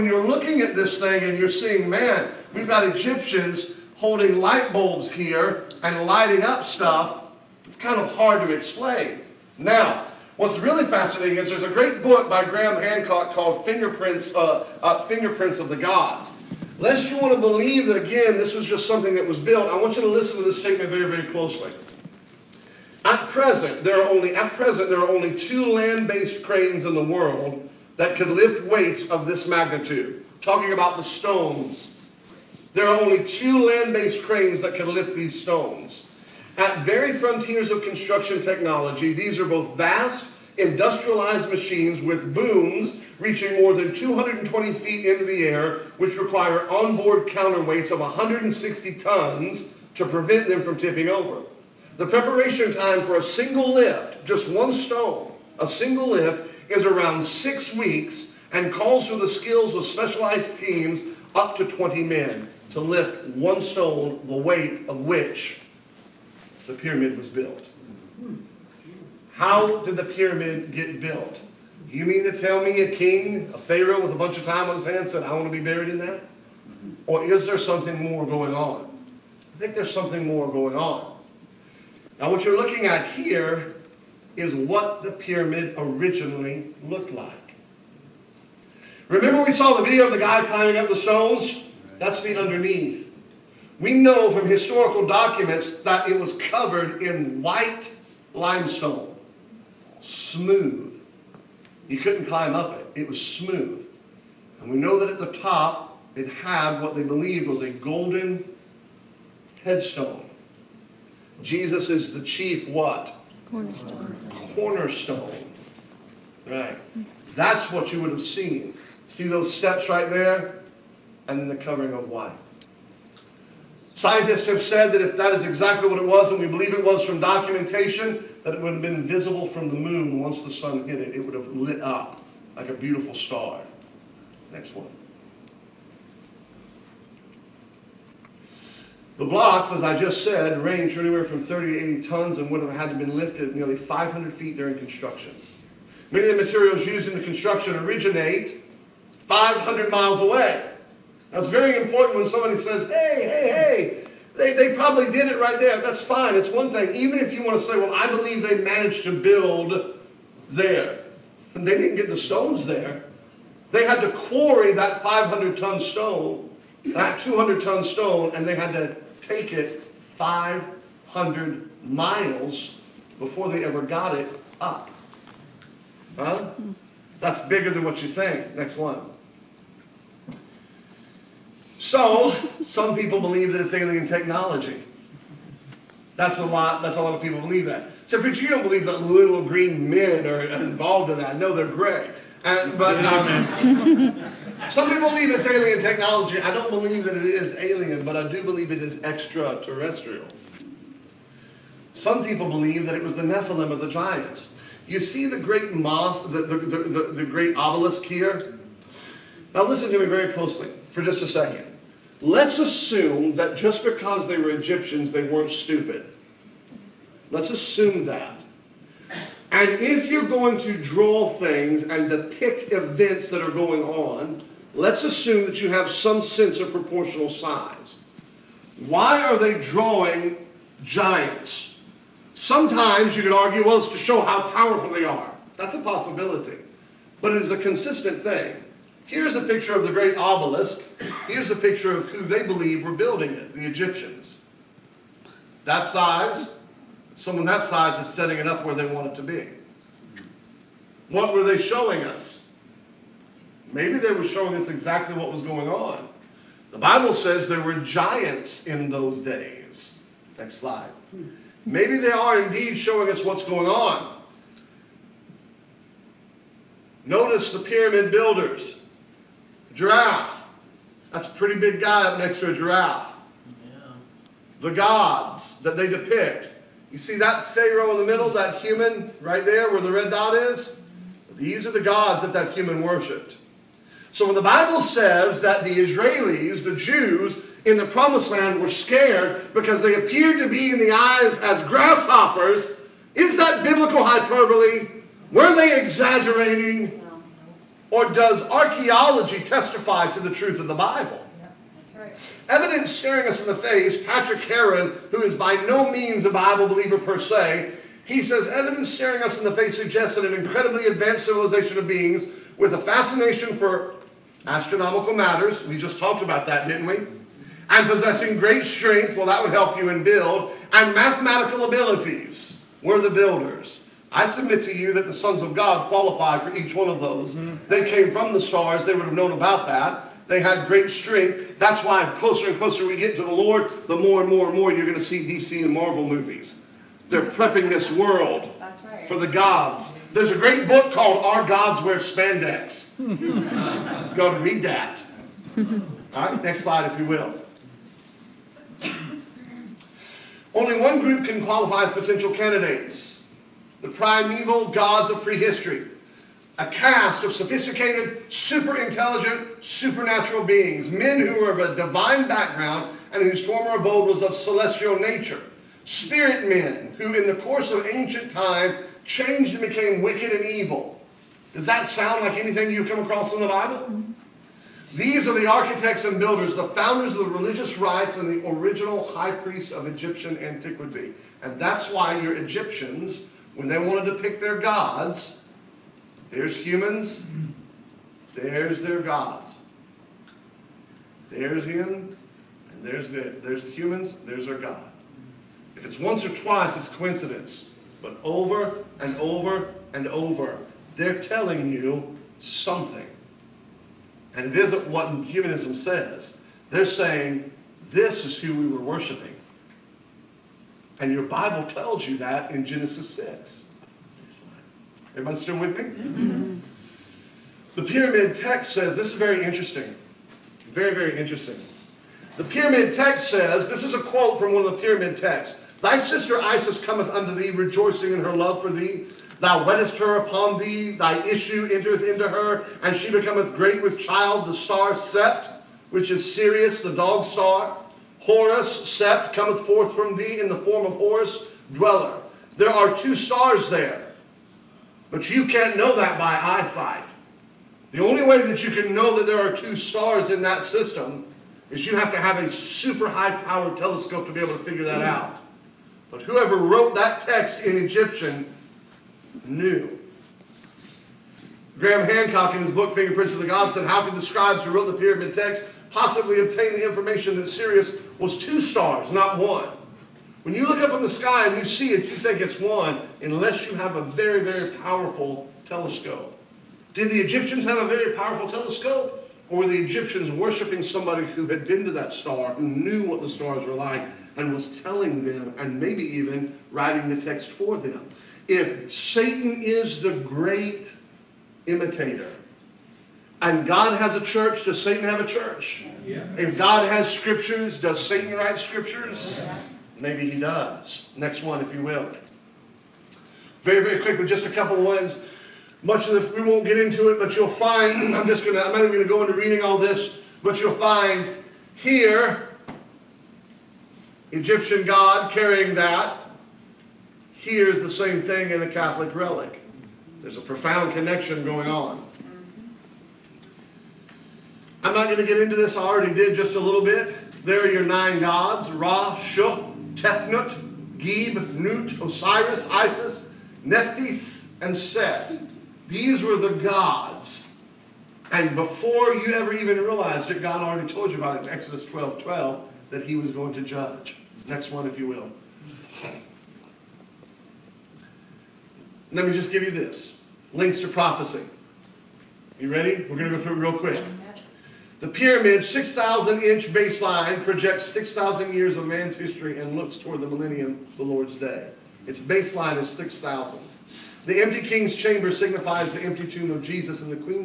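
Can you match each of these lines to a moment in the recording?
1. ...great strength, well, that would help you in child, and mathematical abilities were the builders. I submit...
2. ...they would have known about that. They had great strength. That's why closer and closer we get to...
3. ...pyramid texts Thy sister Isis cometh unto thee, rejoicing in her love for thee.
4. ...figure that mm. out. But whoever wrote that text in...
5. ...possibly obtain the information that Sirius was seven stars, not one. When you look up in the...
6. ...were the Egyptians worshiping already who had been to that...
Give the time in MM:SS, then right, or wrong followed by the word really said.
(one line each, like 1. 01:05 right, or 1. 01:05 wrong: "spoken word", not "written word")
1. 05:18 wrong: "build", not "child"
2. 05:28 right
3. 07:04 right
4. 07:34 right
5. 07:45 wrong: "two", not "seven"
6. 07:59 wrong: "somebody", not "already".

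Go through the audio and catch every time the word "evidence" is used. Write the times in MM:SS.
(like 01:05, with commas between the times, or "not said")
05:02, 05:08.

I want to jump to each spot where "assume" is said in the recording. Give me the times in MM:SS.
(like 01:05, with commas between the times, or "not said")
03:32, 03:37, 03:45.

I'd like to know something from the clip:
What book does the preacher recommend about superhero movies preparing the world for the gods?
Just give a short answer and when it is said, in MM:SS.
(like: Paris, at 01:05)
Our Gods Wear Spandex, at 05:41.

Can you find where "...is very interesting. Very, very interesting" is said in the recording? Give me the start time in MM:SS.
06:59.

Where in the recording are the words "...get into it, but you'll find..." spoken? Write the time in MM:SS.
08:26.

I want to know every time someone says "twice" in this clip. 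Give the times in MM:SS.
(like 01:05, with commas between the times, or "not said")
06:36.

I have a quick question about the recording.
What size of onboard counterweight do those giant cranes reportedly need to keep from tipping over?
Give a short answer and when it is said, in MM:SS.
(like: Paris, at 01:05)
160 tons, at 00:47.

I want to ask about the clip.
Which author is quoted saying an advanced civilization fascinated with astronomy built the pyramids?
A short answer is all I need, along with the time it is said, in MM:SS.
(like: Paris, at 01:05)
Patrick Heron, at 05:04.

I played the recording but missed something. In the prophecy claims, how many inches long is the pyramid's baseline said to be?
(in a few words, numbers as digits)
6,000.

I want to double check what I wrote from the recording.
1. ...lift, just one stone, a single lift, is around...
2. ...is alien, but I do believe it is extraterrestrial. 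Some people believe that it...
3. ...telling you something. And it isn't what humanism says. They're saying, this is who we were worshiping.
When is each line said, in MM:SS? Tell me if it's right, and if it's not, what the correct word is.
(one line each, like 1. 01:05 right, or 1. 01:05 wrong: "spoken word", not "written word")
1. 00:53 right
2. 03:17 right
3. 06:41 right.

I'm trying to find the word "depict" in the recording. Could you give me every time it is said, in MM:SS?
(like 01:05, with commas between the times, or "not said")
03:42, 04:35.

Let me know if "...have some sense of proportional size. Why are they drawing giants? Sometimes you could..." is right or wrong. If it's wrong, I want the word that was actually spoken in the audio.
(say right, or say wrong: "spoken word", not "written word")
right.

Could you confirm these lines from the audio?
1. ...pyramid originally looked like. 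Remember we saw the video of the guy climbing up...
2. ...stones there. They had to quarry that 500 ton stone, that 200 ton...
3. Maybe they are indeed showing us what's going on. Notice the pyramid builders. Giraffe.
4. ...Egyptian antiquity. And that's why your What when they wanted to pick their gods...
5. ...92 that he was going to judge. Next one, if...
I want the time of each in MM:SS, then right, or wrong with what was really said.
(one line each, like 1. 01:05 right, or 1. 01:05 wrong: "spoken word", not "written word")
1. 01:25 right
2. 02:42 right
3. 04:21 right
4. 06:19 wrong: "Egyptians", not "What"
5. 09:02 wrong: "12", not "92".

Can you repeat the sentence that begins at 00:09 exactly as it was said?
Now, What's really fascinating is there's a great book by Graham Hancock called Fingerprints, uh, uh, Fingerprints of the Gods.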